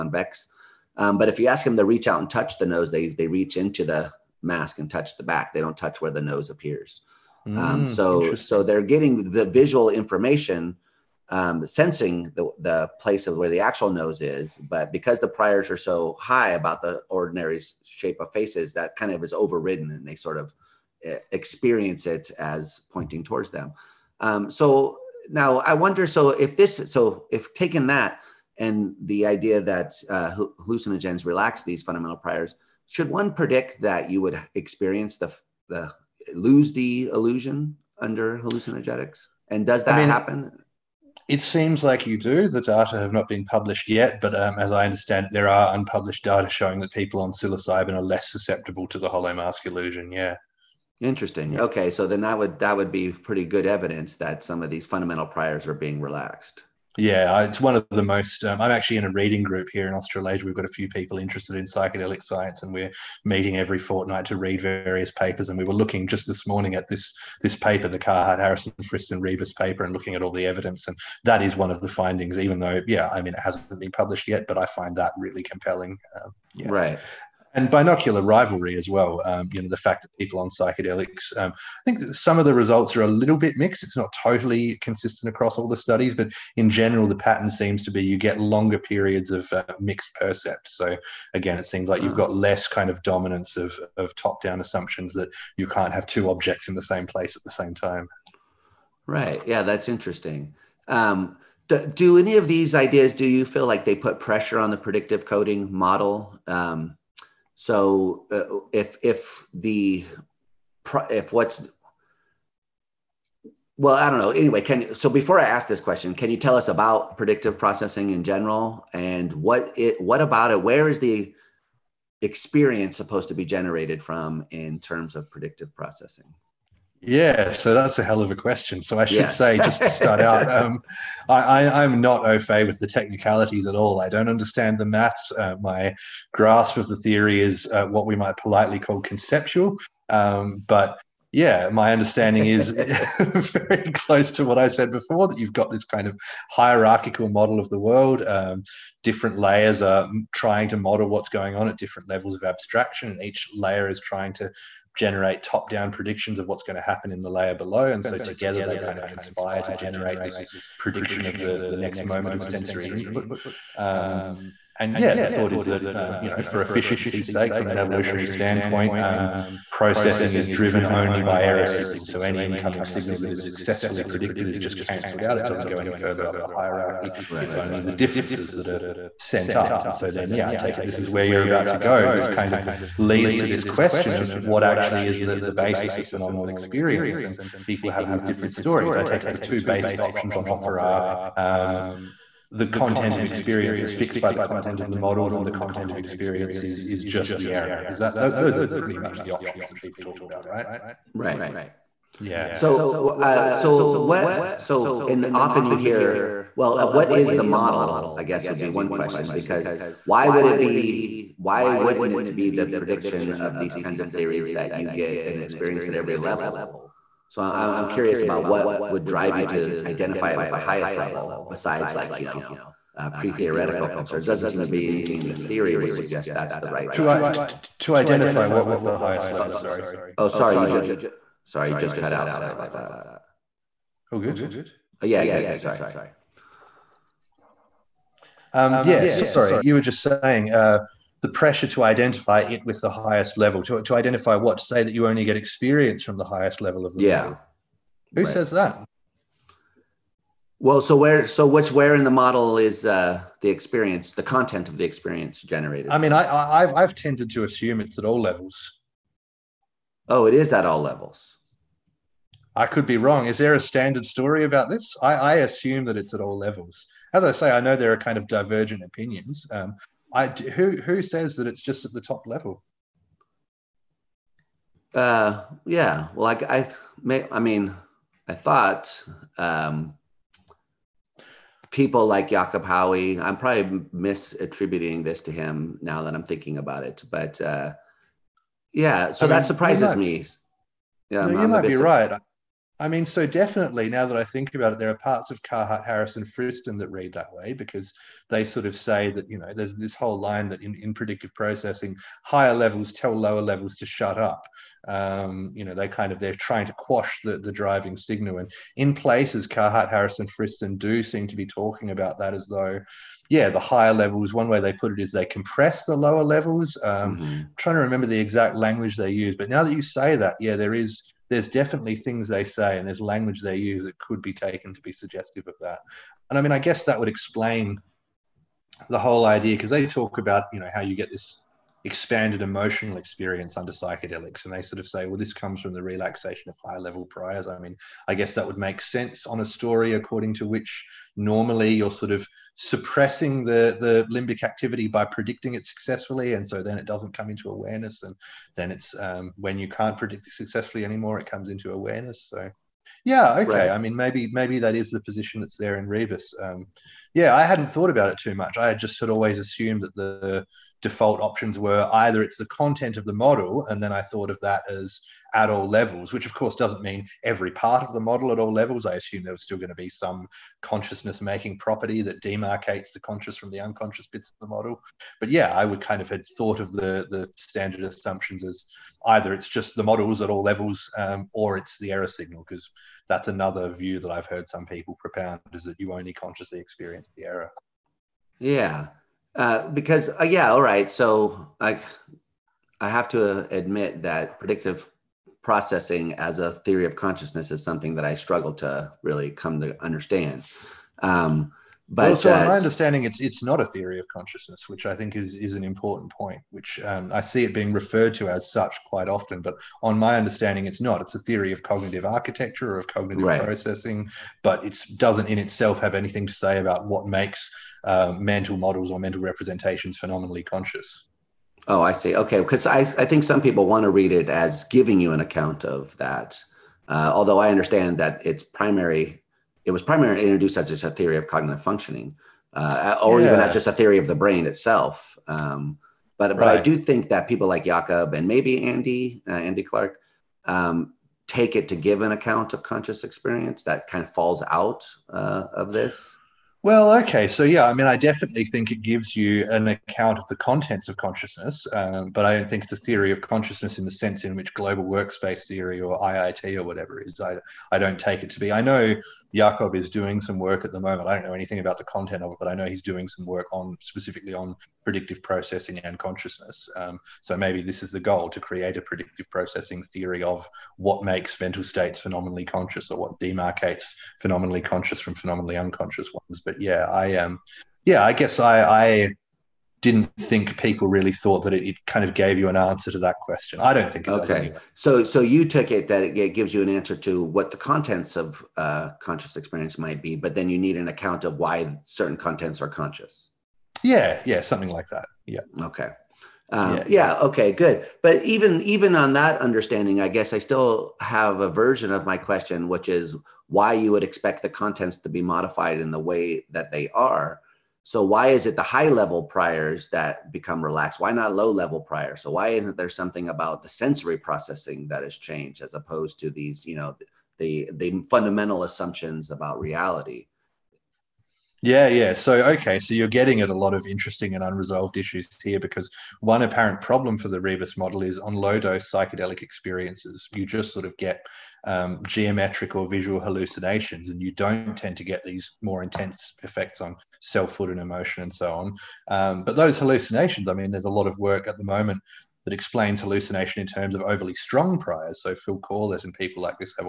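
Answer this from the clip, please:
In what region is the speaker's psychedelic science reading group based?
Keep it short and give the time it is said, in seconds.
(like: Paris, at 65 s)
Australasia, at 59 s.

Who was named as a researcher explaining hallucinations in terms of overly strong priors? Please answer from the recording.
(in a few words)
Phil Corlett.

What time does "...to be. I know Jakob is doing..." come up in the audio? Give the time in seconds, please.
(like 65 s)
458 s.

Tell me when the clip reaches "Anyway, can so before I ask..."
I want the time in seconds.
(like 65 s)
114 s.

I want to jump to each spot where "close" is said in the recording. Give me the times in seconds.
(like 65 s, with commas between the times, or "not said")
143 s.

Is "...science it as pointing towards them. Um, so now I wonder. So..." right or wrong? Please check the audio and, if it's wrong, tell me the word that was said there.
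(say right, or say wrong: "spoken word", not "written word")
wrong: "experience", not "science".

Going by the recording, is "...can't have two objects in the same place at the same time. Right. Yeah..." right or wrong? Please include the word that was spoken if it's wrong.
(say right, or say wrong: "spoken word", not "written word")
right.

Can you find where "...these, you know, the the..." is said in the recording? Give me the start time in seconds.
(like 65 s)
516 s.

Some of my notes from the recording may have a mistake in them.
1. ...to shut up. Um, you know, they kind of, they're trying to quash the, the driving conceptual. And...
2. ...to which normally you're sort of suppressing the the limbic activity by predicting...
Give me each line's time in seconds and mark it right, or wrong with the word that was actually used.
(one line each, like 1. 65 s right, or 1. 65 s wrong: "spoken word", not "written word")
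1. 303 s wrong: "signal", not "conceptual"
2. 340 s right.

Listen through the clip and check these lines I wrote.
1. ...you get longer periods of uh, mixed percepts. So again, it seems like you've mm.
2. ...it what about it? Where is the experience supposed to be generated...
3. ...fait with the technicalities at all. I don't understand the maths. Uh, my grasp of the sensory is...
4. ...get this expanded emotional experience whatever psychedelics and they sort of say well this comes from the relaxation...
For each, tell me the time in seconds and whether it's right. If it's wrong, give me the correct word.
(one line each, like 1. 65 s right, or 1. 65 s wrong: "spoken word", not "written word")
1. 88 s right
2. 119 s right
3. 132 s wrong: "theory", not "sensory"
4. 330 s wrong: "under", not "whatever".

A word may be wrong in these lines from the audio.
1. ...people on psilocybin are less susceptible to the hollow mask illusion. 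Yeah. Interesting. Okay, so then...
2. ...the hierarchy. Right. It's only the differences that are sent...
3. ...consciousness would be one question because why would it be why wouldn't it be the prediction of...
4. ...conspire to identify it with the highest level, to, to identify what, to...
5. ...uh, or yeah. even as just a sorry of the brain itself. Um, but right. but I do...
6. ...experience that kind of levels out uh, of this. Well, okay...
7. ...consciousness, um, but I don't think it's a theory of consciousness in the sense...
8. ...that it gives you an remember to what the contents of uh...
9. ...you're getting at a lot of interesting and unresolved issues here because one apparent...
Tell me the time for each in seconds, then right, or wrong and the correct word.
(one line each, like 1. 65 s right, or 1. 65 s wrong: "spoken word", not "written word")
1. 46 s right
2. 176 s right
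3. 208 s wrong: "guess", not "consciousness"
4. 241 s wrong: "pressure", not "conspire"
5. 432 s wrong: "theory", not "sorry"
6. 443 s wrong: "falls", not "levels"
7. 450 s right
8. 485 s wrong: "answer", not "remember"
9. 522 s right.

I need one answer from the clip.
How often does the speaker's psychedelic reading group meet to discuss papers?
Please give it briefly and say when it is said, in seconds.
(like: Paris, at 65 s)
every fortnight, at 63 s.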